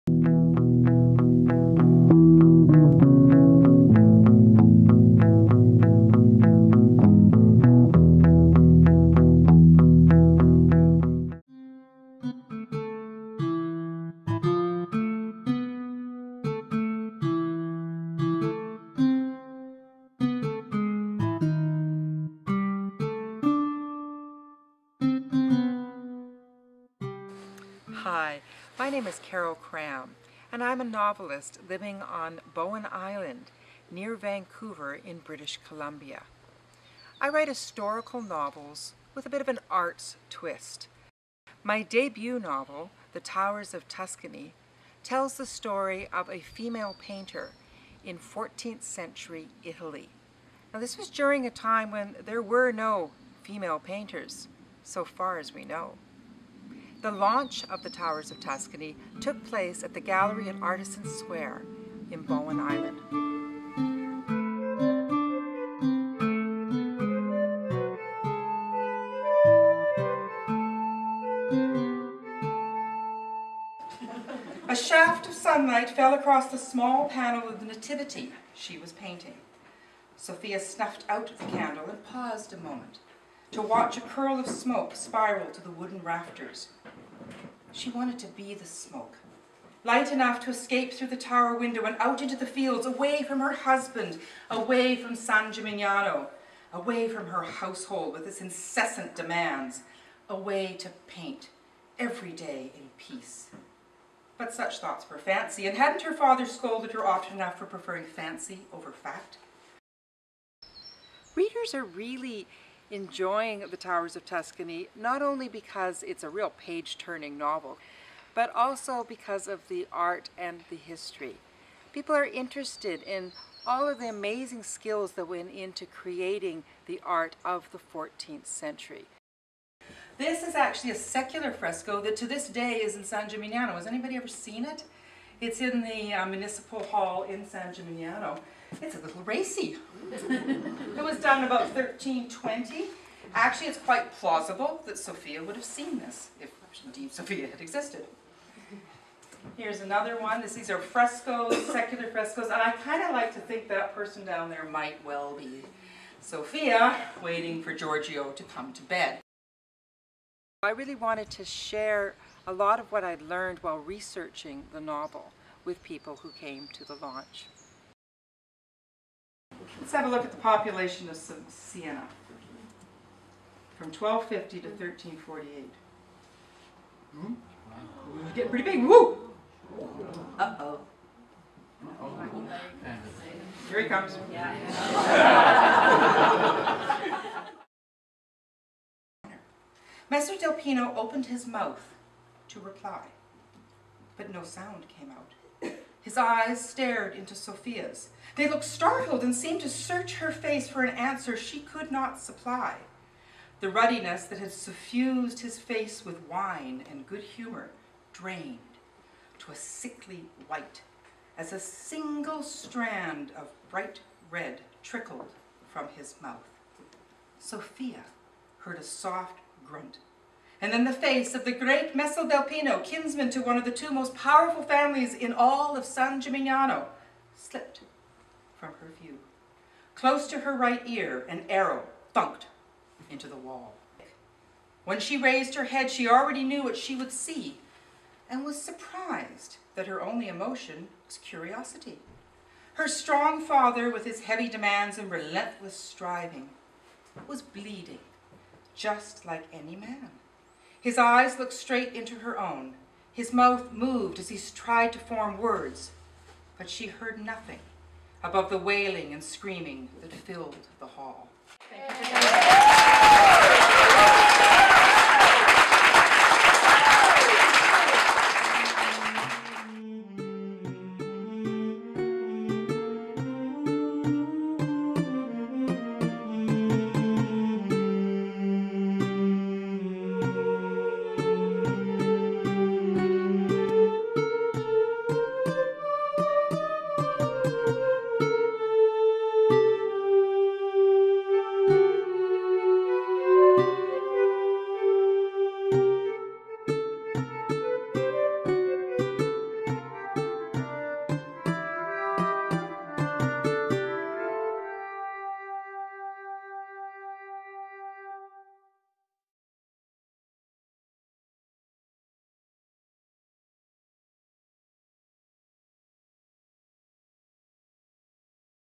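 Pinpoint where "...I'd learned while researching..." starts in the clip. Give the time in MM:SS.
02:43.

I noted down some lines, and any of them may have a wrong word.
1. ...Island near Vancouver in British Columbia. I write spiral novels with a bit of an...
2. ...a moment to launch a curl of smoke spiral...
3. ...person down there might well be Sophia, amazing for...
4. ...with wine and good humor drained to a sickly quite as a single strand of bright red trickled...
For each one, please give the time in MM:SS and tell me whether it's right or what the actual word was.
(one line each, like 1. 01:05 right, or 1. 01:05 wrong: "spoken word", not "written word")
1. 00:32 wrong: "historical", not "spiral"
2. 01:22 wrong: "watch", not "launch"
3. 02:33 wrong: "waiting", not "amazing"
4. 03:26 wrong: "white", not "quite".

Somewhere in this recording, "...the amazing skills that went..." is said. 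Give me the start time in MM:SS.
02:03.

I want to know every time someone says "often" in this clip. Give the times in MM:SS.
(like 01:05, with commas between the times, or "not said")
01:47.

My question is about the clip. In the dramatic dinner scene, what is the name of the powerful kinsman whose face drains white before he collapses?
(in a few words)
Messer Del Pino.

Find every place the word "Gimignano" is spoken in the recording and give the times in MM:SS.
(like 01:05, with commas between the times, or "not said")
01:35, 02:13, 02:17, 03:46.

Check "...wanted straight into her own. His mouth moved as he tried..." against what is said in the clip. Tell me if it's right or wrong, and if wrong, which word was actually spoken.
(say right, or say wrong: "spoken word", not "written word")
wrong: "looked", not "wanted".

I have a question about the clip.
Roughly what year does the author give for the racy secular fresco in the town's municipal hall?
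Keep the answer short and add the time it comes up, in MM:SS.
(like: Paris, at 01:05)
1320, at 02:21.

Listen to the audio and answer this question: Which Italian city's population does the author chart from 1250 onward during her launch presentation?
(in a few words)
Siena.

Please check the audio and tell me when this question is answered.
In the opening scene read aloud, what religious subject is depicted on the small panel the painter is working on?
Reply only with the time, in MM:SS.
01:17.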